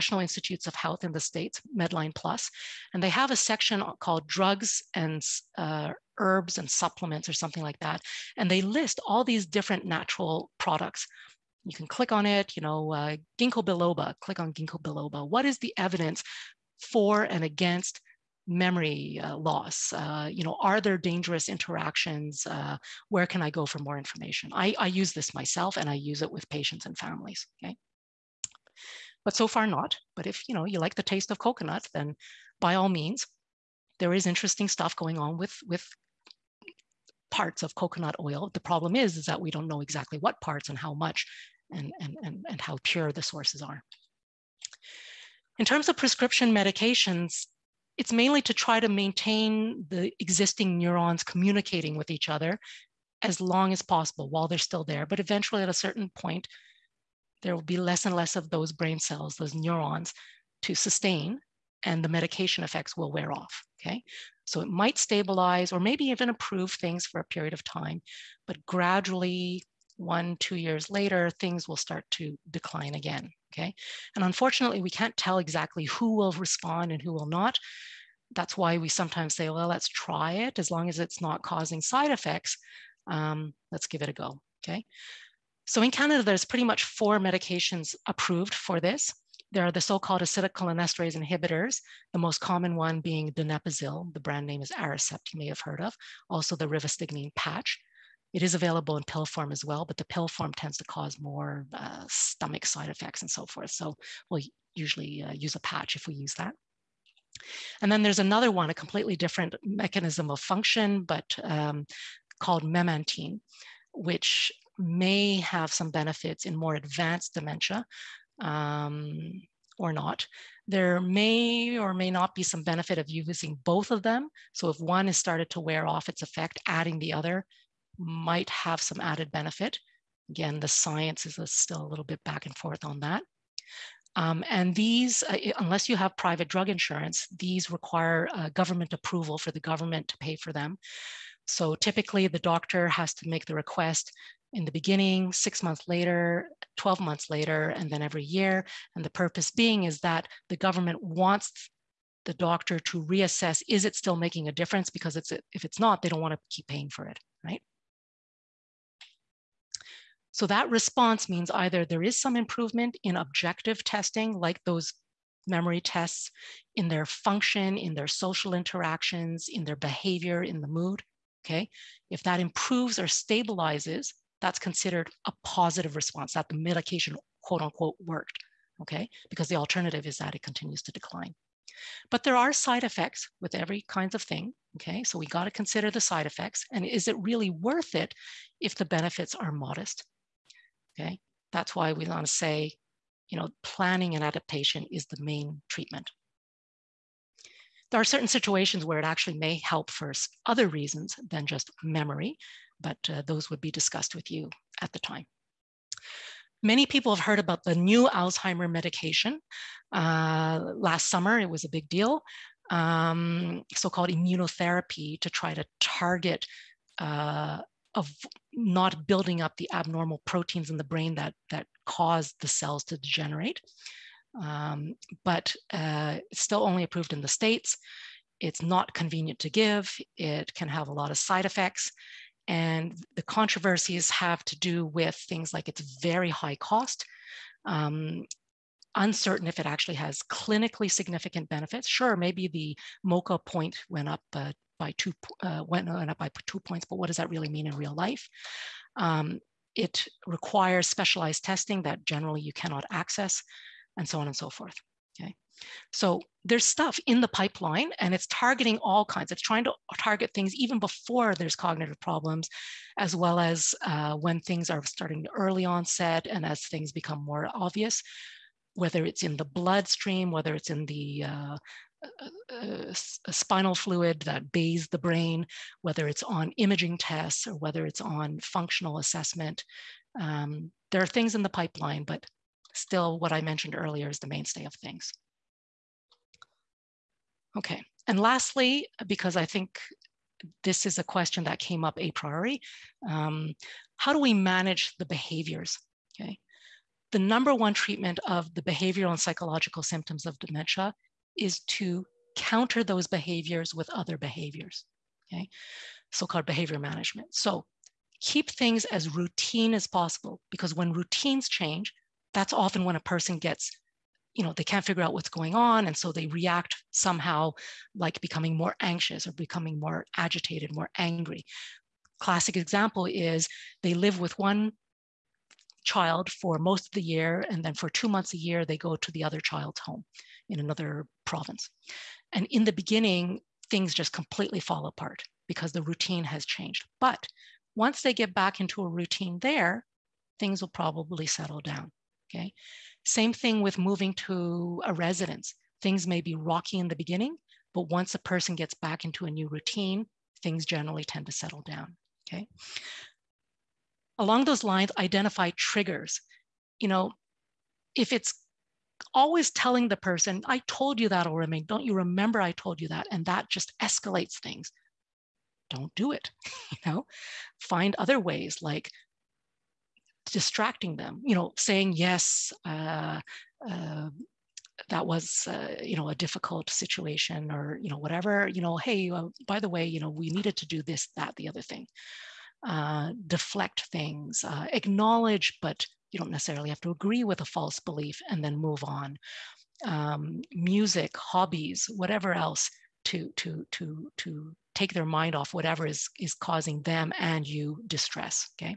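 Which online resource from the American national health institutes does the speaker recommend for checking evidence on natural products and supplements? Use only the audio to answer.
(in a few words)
Medline Plus.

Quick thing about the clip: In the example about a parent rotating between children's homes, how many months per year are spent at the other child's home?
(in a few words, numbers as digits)
2.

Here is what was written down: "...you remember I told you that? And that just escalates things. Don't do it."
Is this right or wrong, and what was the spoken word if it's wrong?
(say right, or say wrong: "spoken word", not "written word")
right.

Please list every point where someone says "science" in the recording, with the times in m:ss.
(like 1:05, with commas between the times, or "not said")
2:10.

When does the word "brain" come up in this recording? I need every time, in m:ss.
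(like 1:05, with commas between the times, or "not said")
0:58, 3:40, 4:34.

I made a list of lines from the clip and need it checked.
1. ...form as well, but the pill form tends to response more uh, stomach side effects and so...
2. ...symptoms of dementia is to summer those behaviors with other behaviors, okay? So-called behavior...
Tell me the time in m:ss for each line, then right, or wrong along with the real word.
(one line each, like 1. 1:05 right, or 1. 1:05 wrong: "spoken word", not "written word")
1. 1:39 wrong: "cause", not "response"
2. 4:59 wrong: "counter", not "summer".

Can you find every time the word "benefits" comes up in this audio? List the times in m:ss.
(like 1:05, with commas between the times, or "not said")
1:55, 2:02, 2:09, 3:08, 4:01.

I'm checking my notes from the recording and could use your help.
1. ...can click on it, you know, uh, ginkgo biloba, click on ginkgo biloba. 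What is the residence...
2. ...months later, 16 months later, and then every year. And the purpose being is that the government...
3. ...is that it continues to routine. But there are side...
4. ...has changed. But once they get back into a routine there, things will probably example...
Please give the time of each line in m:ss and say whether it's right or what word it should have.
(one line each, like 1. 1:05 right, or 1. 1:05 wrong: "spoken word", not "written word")
1. 0:11 wrong: "evidence", not "residence"
2. 2:25 wrong: "12", not "16"
3. 3:00 wrong: "decline", not "routine"
4. 5:36 wrong: "settle", not "example".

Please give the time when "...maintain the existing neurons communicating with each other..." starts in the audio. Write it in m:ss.
0:48.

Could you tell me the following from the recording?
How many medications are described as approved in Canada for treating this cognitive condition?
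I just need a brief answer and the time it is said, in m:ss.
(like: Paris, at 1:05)
4, at 1:26.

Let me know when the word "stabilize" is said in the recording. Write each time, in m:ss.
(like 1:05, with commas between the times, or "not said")
1:04, 2:53.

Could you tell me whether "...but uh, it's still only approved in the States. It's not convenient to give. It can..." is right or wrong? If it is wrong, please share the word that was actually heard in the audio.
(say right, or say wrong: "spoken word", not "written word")
right.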